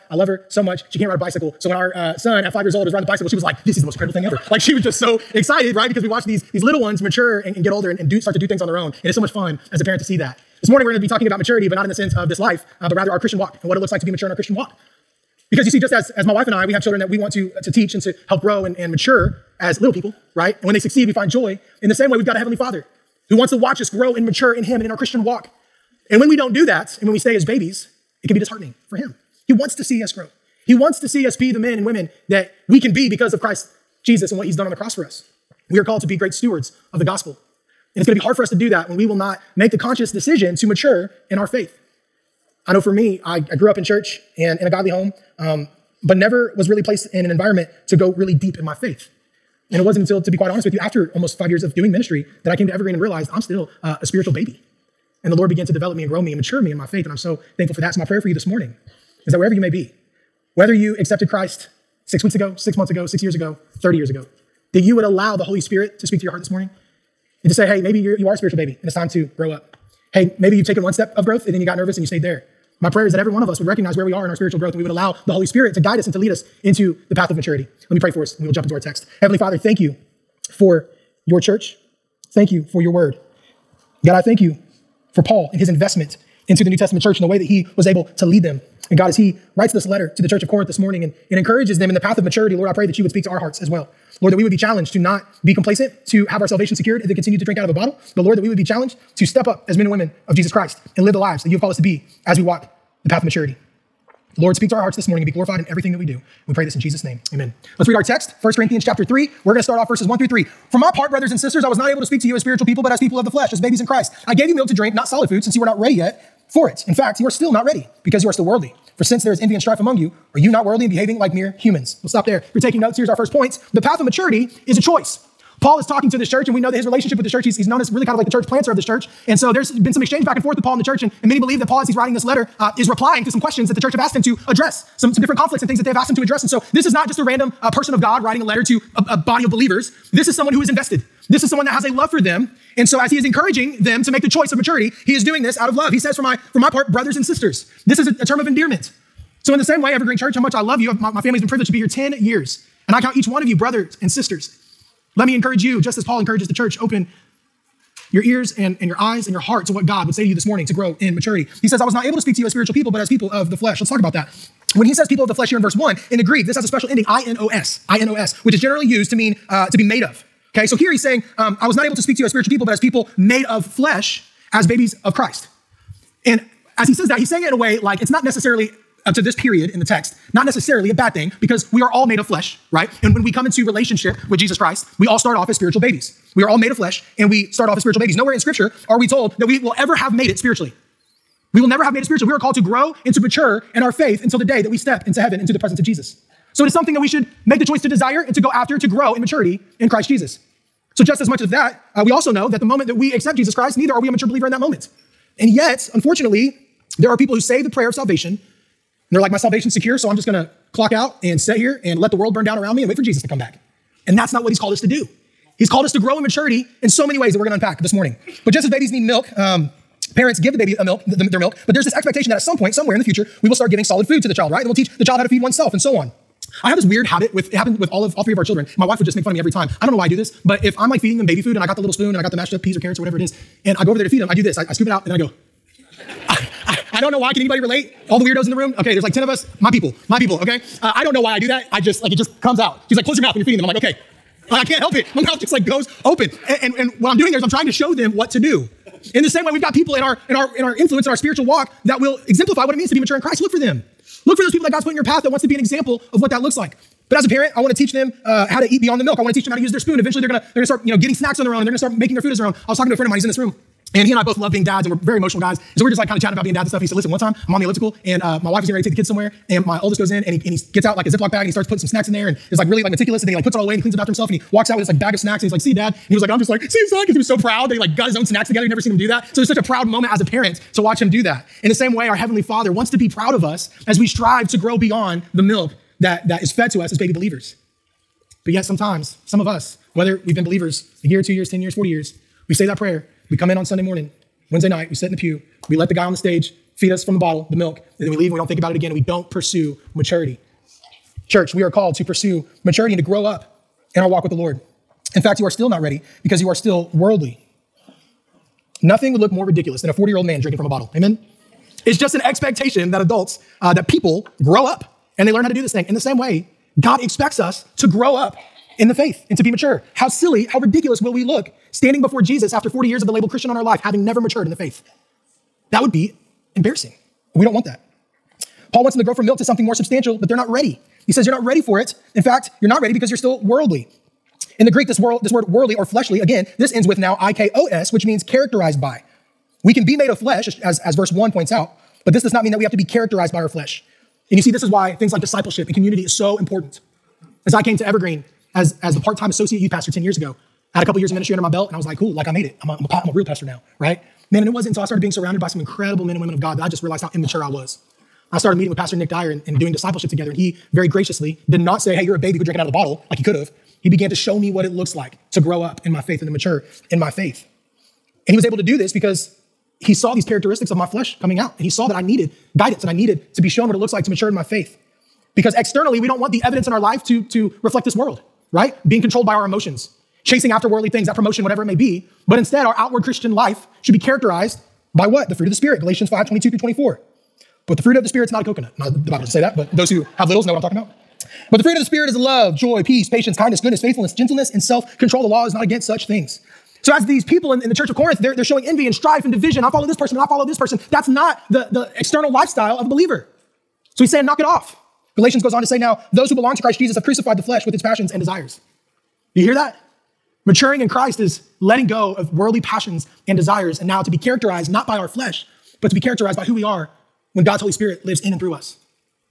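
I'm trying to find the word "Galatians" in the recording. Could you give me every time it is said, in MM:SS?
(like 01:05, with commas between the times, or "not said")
06:25, 06:45.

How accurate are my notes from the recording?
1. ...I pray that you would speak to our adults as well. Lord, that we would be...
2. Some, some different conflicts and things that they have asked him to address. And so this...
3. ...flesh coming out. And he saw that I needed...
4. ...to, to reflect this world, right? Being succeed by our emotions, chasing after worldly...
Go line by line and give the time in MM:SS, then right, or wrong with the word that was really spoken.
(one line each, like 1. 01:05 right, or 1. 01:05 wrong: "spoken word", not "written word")
1. 01:32 wrong: "hearts", not "adults"
2. 02:14 right
3. 06:10 right
4. 06:17 wrong: "controlled", not "succeed".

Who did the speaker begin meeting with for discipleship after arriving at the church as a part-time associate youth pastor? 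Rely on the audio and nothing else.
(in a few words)
Pastor Nick Dyer.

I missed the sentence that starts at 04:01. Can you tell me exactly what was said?
I just, like, it just comes out.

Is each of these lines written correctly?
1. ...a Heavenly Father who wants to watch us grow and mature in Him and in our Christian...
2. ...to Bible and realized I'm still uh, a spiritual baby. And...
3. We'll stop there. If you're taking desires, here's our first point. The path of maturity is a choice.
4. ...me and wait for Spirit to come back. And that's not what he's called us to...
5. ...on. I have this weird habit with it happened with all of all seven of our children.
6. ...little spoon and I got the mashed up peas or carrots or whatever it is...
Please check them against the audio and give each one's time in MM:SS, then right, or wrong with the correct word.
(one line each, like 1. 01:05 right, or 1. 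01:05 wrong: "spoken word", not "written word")
1. 00:22 right
2. 00:52 wrong: "Evergreen", not "Bible"
3. 02:02 wrong: "notes", not "desires"
4. 03:32 wrong: "Jesus", not "Spirit"
5. 03:45 wrong: "three", not "seven"
6. 03:51 right.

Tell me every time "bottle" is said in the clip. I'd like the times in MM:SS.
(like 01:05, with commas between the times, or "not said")
01:37, 04:57, 05:10, 06:02.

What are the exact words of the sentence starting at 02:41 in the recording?
He says, I was not able to speak to you as spiritual people, but as people of the flesh.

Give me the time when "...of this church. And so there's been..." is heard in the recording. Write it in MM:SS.
02:08.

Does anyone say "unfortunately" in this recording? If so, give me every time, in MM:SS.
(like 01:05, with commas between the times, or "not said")
03:25.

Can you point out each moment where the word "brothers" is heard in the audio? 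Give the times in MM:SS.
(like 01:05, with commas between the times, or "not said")
01:51, 02:26, 02:33.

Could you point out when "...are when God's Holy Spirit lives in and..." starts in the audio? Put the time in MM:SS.
06:56.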